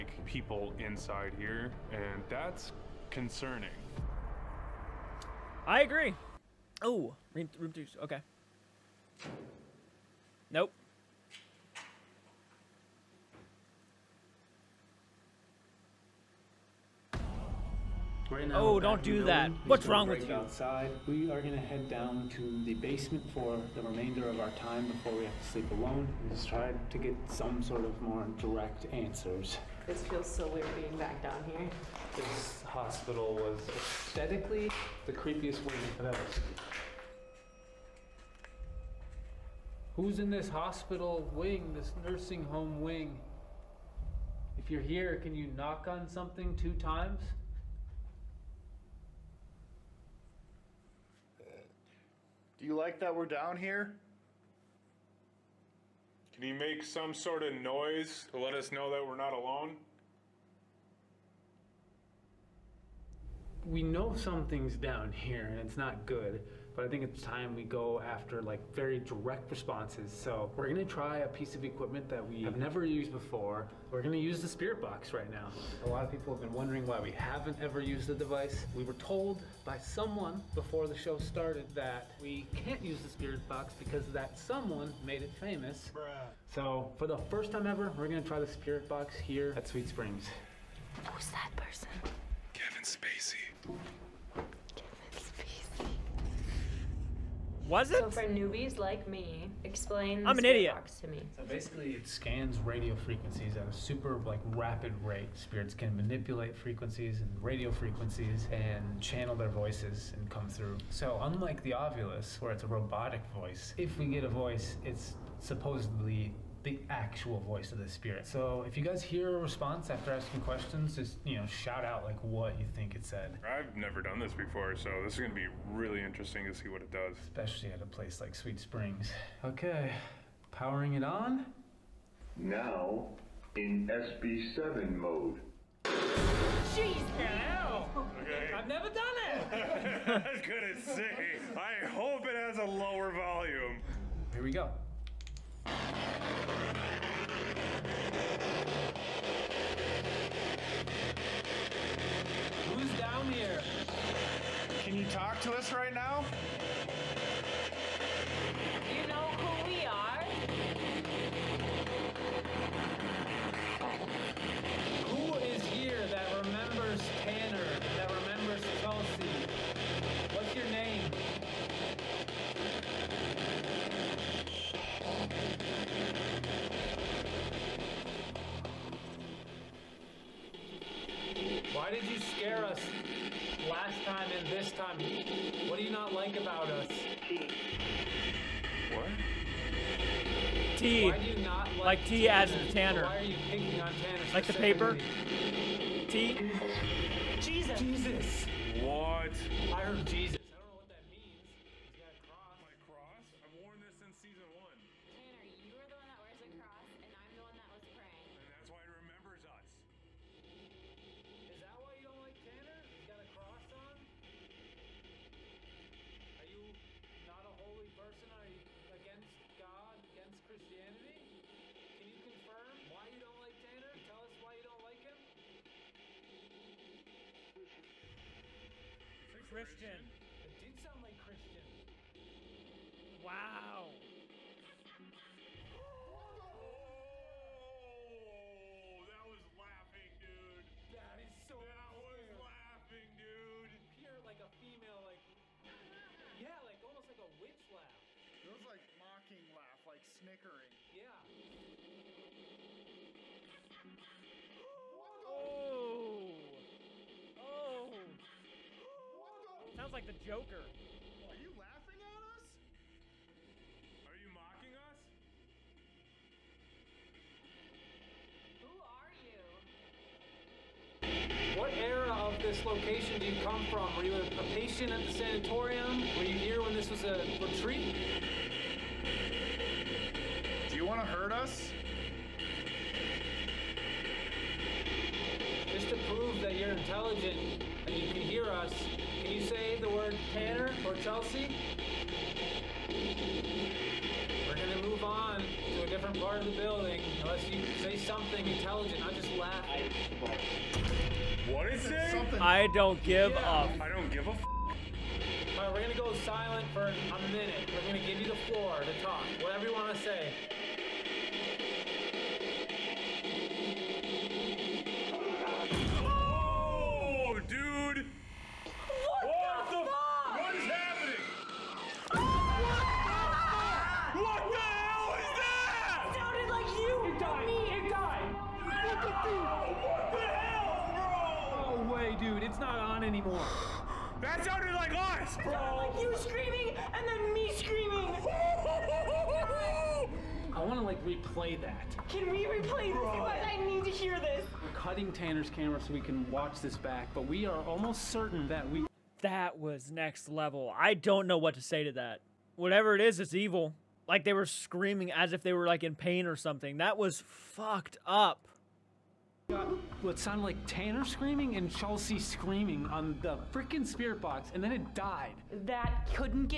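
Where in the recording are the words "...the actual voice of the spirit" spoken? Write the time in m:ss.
1:56.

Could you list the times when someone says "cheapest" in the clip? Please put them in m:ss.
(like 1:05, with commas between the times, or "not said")
not said.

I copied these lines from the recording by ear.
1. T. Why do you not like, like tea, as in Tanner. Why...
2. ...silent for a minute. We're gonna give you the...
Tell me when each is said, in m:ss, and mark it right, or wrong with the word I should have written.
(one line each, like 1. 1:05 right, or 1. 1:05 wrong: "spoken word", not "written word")
1. 3:10 right
2. 5:06 right.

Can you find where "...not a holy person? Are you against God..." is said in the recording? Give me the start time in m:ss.
3:37.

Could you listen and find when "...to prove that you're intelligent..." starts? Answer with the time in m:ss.
4:45.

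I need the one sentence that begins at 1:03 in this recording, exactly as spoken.
We know something's down here and it's not good but I think it's time we go after like very direct responses.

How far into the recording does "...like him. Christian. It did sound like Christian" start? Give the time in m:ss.
3:44.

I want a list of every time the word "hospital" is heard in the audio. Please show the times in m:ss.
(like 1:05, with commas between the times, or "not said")
0:32, 0:40.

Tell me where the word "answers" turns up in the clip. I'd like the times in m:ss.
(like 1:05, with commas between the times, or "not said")
0:28.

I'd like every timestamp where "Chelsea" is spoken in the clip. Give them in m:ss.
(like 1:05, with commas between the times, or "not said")
4:50, 6:01.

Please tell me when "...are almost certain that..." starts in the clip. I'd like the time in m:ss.
5:47.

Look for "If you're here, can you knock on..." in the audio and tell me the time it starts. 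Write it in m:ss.
0:44.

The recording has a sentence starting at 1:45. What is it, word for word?
Spirits can manipulate frequencies and radio frequencies and channel their voices and come through.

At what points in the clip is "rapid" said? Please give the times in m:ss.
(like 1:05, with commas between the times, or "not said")
1:44.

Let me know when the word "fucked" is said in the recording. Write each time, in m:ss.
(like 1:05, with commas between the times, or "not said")
5:57.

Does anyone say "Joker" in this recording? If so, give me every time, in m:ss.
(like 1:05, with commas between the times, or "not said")
4:20.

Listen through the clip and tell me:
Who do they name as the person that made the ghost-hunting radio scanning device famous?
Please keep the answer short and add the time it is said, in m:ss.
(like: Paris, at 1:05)
Kevin Spacey, at 1:32.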